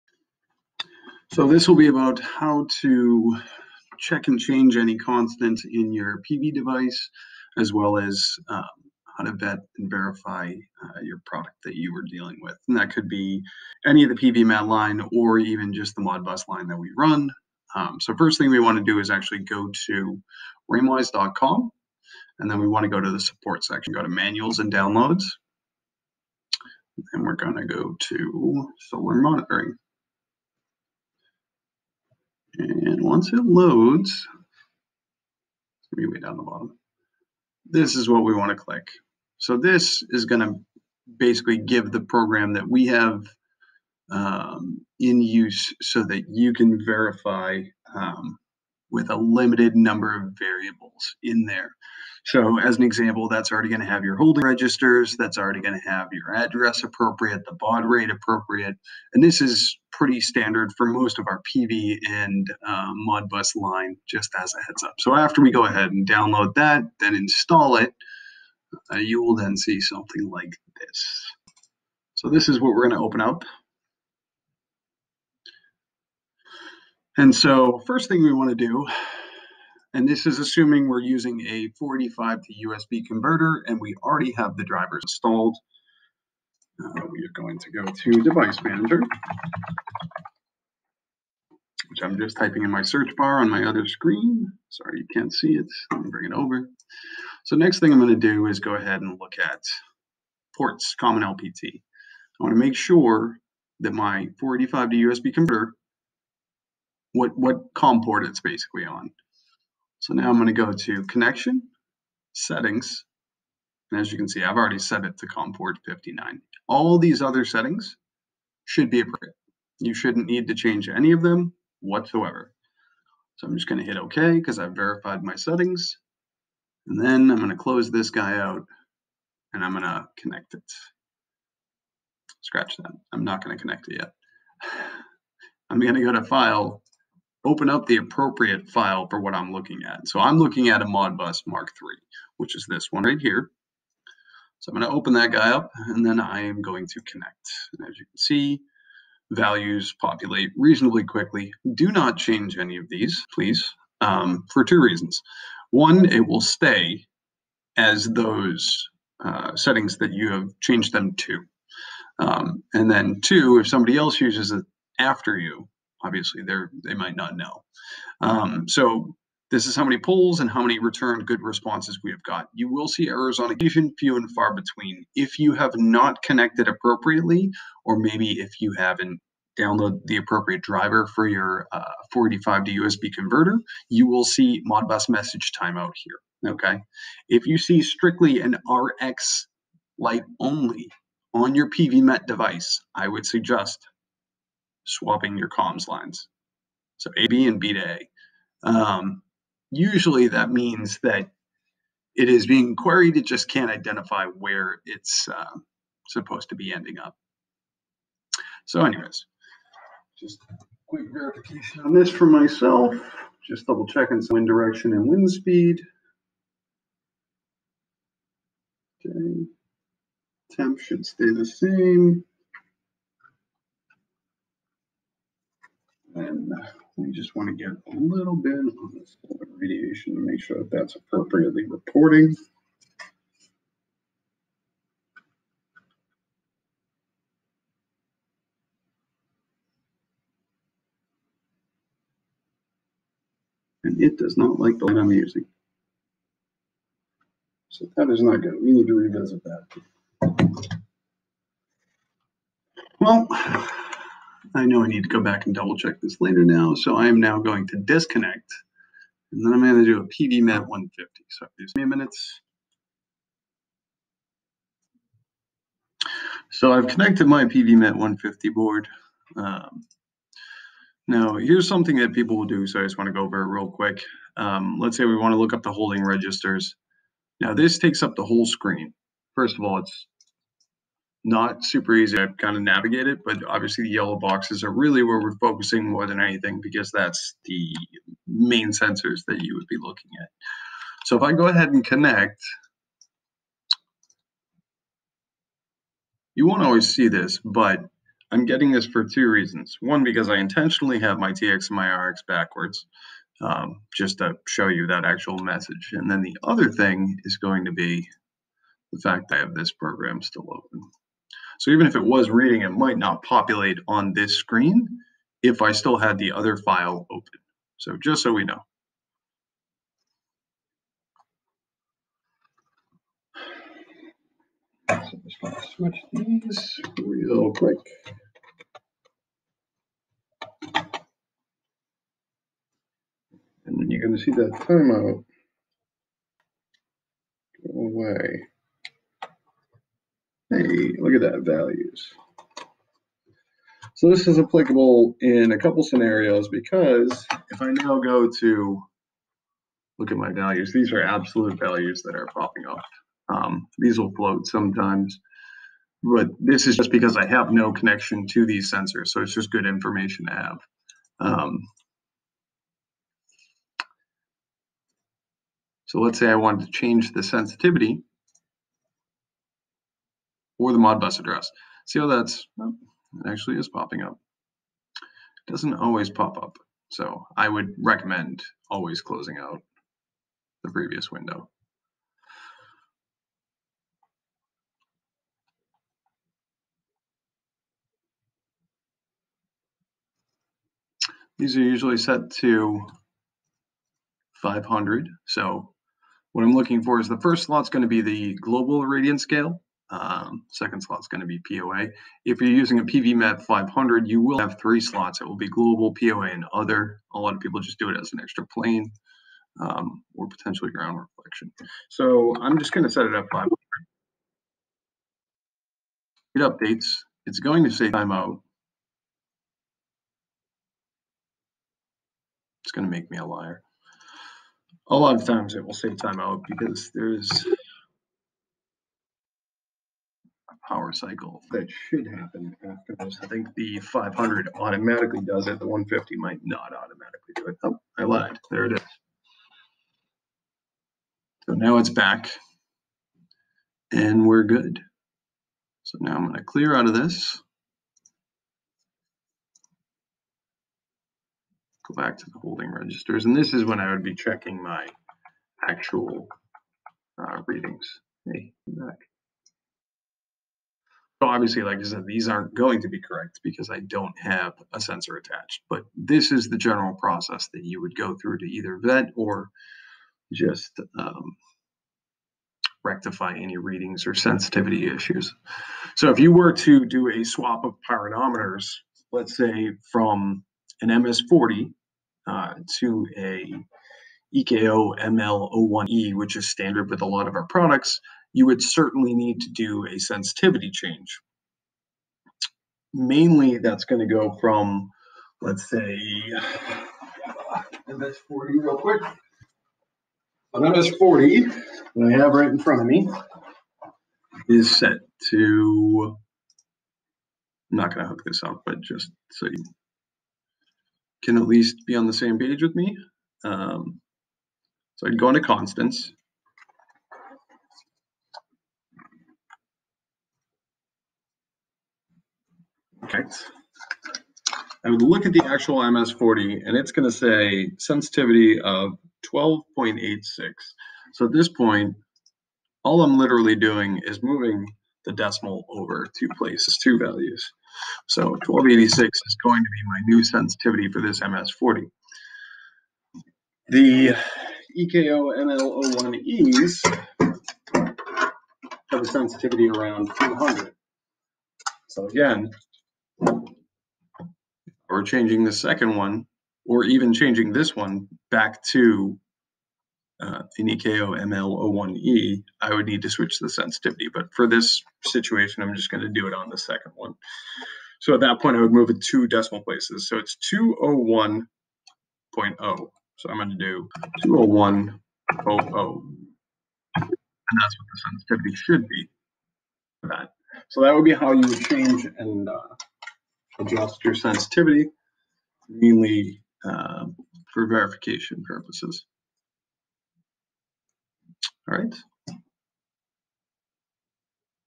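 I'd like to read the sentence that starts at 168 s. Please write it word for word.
Um, so this is how many polls and how many return good responses we have got.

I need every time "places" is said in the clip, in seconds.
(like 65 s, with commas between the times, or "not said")
536 s, 569 s.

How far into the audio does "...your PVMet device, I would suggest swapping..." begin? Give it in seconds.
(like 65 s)
191 s.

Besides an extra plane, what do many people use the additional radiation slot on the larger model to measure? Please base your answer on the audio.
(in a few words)
ground reflection.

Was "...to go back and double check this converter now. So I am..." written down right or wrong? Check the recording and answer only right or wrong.
wrong.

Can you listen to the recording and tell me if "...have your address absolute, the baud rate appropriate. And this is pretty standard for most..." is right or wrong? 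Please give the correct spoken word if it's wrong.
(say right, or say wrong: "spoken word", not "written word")
wrong: "appropriate", not "absolute".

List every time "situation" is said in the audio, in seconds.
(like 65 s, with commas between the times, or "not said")
565 s.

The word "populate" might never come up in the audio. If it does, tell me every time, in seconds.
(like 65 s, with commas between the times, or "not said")
149 s, 313 s.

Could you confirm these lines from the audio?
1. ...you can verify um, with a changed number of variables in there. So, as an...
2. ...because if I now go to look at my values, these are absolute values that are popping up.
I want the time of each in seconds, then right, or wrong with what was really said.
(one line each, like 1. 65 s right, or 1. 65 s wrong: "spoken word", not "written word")
1. 46 s wrong: "limited", not "changed"
2. 346 s right.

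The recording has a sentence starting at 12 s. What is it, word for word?
And that could be any of the PVMet line or even just the Modbus line that we run.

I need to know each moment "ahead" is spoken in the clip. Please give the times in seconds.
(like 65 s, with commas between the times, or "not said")
65 s, 98 s, 291 s.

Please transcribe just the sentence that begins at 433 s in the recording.
I think the 500 automatically does it.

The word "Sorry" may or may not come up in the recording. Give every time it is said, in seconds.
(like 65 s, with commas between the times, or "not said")
94 s.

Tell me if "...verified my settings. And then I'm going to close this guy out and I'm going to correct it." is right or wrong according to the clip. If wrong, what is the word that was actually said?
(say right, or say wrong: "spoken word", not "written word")
wrong: "connect", not "correct".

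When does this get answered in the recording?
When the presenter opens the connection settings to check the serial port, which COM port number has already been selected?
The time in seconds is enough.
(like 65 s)
115 s.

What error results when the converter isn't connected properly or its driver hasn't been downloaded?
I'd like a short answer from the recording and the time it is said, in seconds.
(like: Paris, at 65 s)
Modbus message timeout, at 184 s.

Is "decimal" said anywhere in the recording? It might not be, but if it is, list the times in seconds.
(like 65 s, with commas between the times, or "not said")
535 s, 569 s.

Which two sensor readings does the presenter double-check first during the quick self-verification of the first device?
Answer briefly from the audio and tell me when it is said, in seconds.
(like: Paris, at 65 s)
wind direction and wind speed, at 214 s.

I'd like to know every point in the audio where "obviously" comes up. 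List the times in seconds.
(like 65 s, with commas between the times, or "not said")
166 s, 283 s, 461 s.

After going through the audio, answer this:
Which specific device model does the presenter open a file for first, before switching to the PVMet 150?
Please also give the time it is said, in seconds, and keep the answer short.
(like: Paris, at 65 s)
Modbus Mark III, at 140 s.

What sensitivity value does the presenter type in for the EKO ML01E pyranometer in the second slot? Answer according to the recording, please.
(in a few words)
201.00.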